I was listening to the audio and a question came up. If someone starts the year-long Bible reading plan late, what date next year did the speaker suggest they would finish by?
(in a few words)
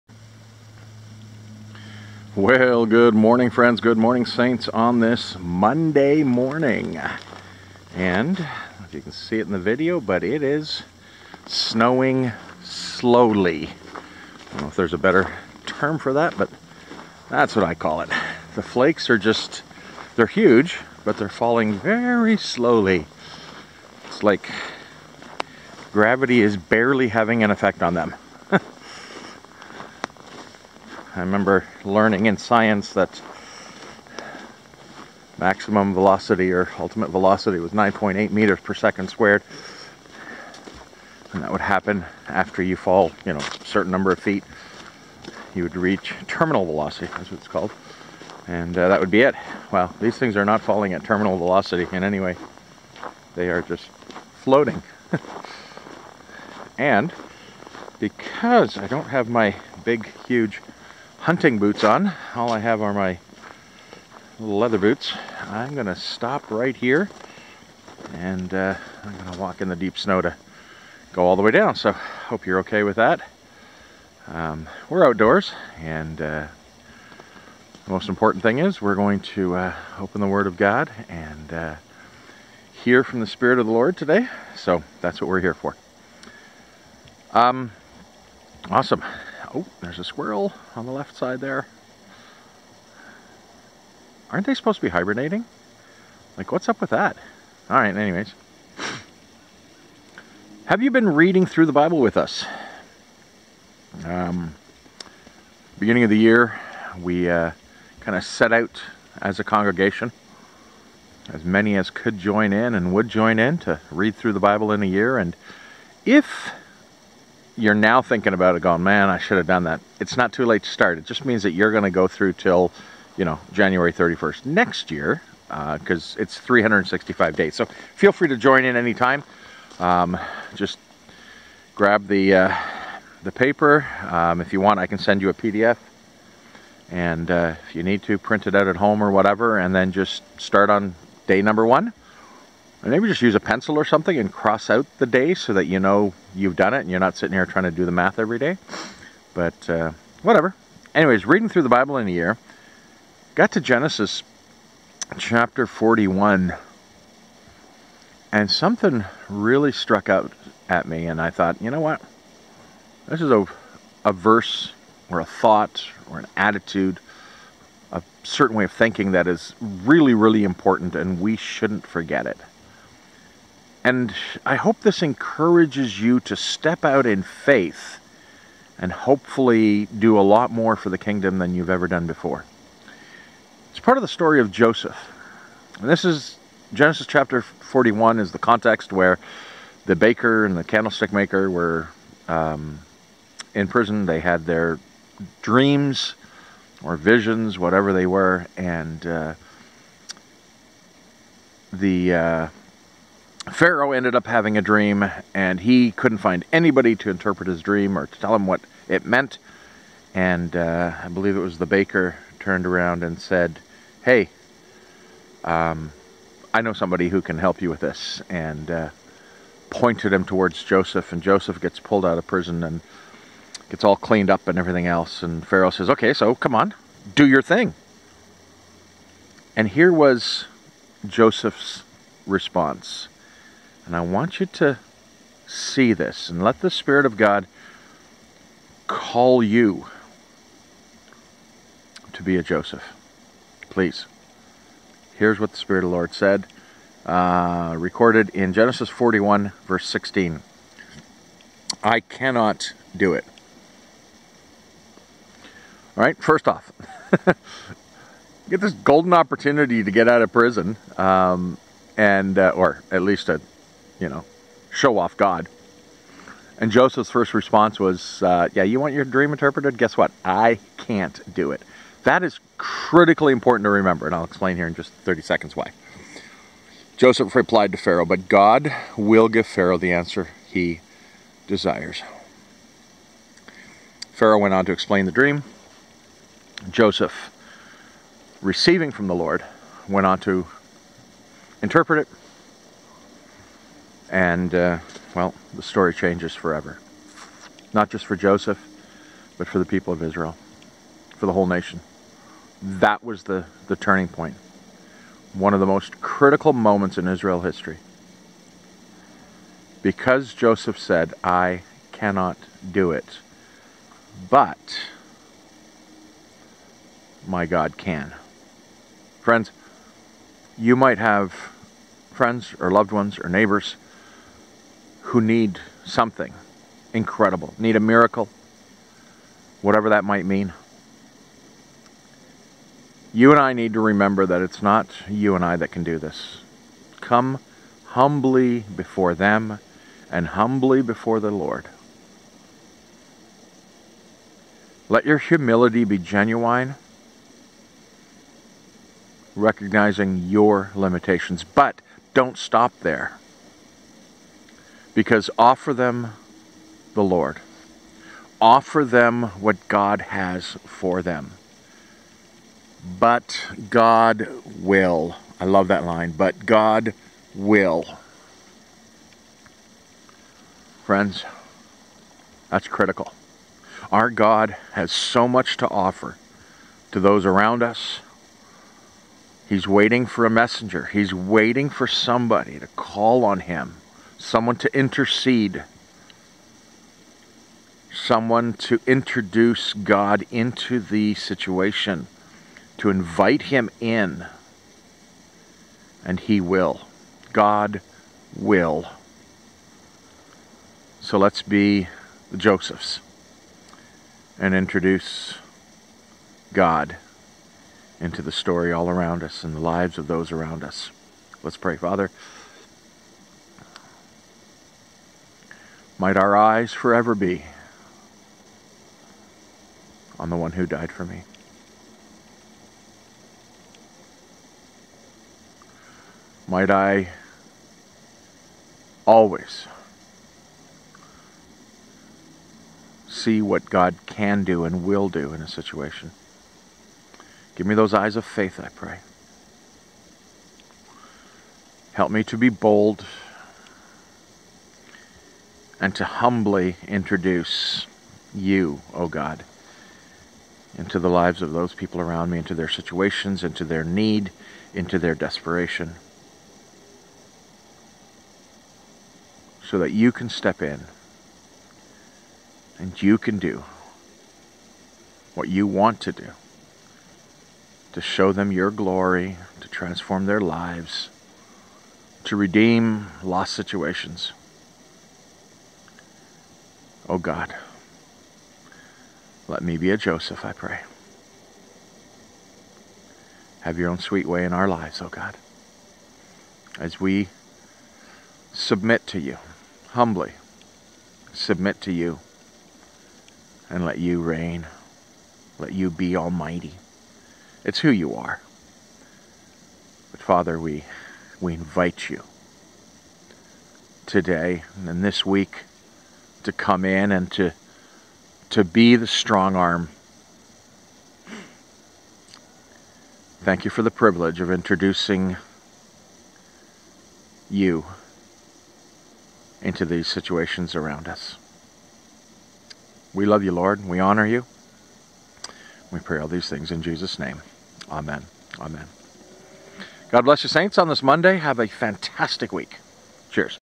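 January 31st.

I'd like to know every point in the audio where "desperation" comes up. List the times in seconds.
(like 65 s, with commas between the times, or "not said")
455 s.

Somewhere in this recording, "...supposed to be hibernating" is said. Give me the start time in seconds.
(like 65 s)
94 s.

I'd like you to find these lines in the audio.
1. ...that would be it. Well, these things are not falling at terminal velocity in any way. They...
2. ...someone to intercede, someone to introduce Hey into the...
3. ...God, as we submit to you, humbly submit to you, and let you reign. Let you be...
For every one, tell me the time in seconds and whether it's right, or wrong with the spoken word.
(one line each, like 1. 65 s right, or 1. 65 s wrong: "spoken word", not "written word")
1. 48 s right
2. 384 s wrong: "God", not "Hey"
3. 485 s right.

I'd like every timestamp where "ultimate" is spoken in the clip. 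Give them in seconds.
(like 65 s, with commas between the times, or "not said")
36 s.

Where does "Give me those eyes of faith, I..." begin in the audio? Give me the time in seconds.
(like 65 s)
437 s.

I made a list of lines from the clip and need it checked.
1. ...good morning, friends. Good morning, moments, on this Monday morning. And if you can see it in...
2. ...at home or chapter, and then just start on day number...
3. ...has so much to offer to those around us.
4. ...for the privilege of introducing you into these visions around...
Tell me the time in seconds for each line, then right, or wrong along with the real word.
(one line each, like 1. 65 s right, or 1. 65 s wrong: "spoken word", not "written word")
1. 2 s wrong: "saints", not "moments"
2. 138 s wrong: "whatever", not "chapter"
3. 374 s right
4. 513 s wrong: "situations", not "visions".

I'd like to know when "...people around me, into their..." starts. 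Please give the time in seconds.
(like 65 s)
451 s.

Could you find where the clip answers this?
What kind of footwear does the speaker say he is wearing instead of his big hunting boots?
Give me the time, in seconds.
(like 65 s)
64 s.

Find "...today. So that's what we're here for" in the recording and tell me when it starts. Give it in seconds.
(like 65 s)
83 s.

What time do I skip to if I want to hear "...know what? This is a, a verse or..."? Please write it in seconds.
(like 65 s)
161 s.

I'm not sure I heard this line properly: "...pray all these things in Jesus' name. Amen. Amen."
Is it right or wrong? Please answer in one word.
right.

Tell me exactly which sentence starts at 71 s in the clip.
So hope you're okay with that.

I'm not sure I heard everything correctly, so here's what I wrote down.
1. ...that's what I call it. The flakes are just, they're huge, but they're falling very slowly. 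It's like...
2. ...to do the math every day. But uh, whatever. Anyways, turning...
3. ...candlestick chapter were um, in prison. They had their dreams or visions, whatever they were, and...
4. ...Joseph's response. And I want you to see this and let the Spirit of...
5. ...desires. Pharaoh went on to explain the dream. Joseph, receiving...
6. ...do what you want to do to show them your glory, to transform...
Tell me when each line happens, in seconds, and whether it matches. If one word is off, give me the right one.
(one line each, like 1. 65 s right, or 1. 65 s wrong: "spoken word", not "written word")
1. 17 s right
2. 147 s wrong: "reading", not "turning"
3. 190 s wrong: "maker", not "chapter"
4. 231 s right
5. 281 s right
6. 463 s right.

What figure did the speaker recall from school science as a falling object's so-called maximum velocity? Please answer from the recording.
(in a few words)
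9.8 meters per second squared.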